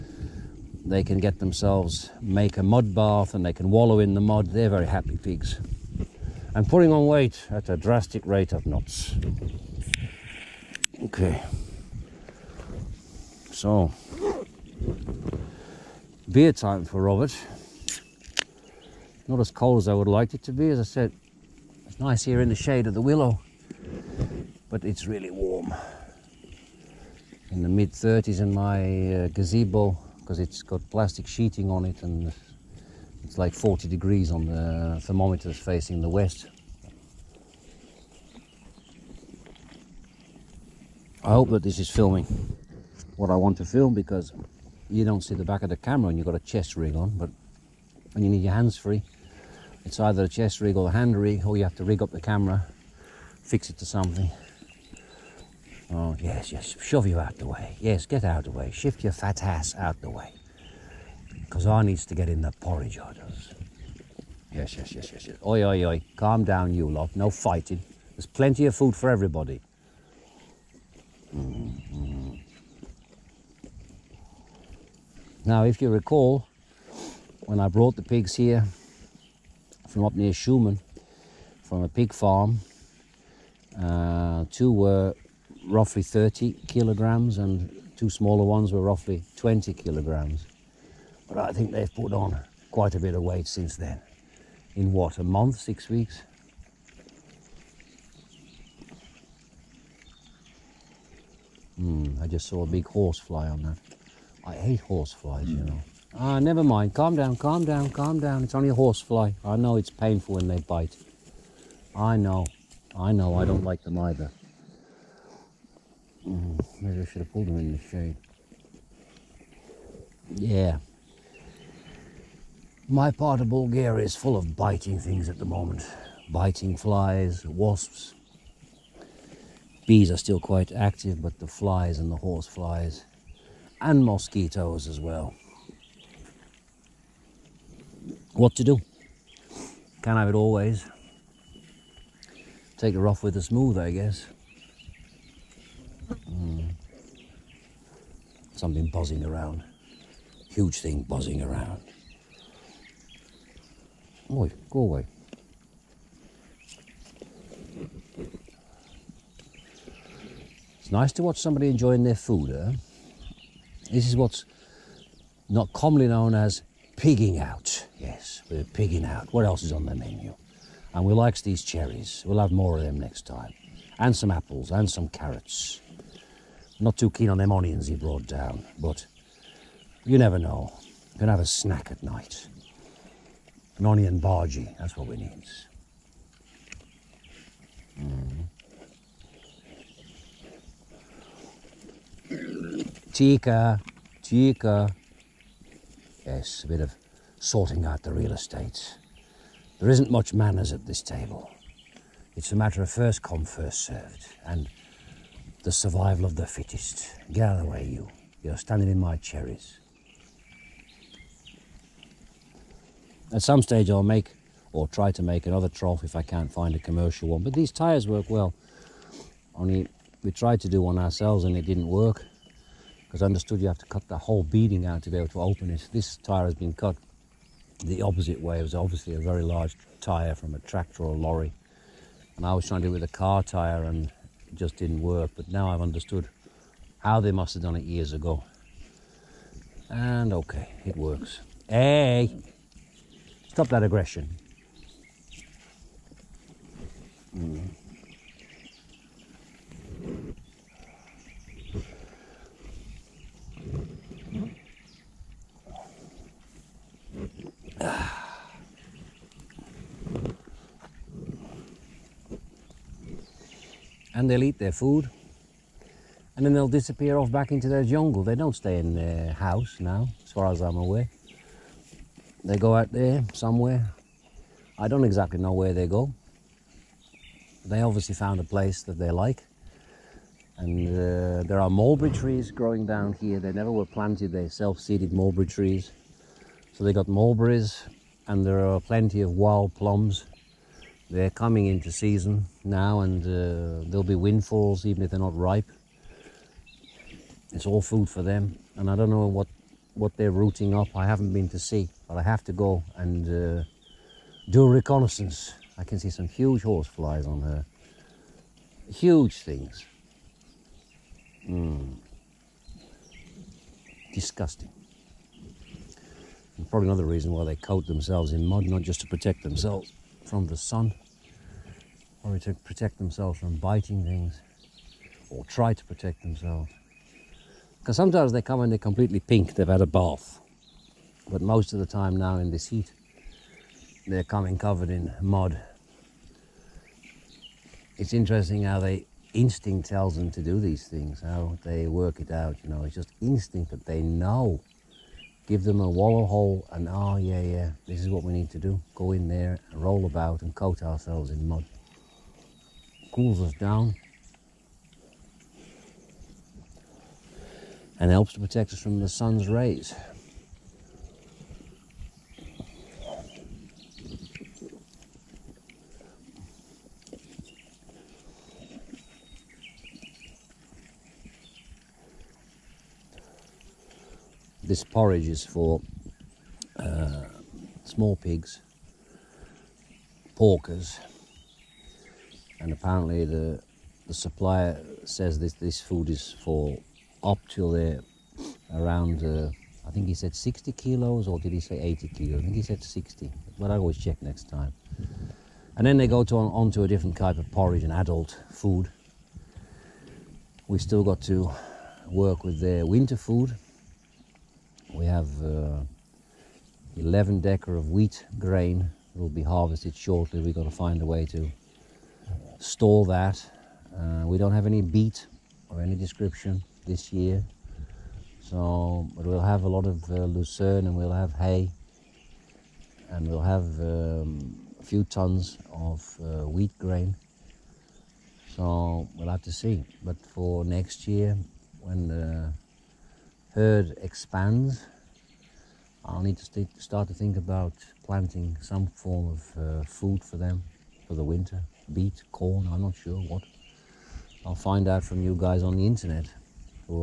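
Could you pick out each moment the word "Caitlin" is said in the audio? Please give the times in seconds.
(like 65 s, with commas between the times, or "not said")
not said.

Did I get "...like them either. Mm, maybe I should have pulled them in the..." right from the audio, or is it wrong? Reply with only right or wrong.
right.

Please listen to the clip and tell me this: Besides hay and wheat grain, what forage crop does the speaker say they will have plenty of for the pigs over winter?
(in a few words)
Lucerne.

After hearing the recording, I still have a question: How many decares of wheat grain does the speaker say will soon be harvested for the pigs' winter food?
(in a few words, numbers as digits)
11.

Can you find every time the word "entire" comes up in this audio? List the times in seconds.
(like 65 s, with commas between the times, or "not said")
not said.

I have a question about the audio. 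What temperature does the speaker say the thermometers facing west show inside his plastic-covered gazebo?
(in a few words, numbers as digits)
40 degrees.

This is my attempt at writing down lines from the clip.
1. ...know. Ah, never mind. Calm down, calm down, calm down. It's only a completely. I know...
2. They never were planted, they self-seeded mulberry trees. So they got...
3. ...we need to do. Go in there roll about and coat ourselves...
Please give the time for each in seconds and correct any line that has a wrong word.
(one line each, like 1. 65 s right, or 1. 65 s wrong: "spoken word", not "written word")
1. 105 s wrong: "horsefly", not "completely"
2. 283 s right
3. 348 s right.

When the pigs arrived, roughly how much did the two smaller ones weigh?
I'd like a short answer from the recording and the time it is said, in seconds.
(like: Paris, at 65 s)
20 kilograms, at 89 s.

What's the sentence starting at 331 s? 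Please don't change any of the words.
But most of the time now in this heat, they're coming covered in mud.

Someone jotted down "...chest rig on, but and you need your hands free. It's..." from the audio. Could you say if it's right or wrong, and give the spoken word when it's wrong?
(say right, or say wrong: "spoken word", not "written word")
right.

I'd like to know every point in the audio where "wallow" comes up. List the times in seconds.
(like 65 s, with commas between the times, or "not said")
3 s, 345 s.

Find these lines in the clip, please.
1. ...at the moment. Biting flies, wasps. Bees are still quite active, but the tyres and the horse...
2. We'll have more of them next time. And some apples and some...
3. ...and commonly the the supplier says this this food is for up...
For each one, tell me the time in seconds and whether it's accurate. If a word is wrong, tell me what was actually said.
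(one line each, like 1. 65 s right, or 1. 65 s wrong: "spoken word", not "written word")
1. 125 s wrong: "flies", not "tyres"
2. 172 s right
3. 382 s wrong: "apparently", not "commonly".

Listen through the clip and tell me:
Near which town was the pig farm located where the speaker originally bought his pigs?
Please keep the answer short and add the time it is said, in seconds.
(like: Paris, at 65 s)
Shumen, at 80 s.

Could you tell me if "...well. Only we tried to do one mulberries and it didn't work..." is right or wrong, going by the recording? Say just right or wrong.
wrong.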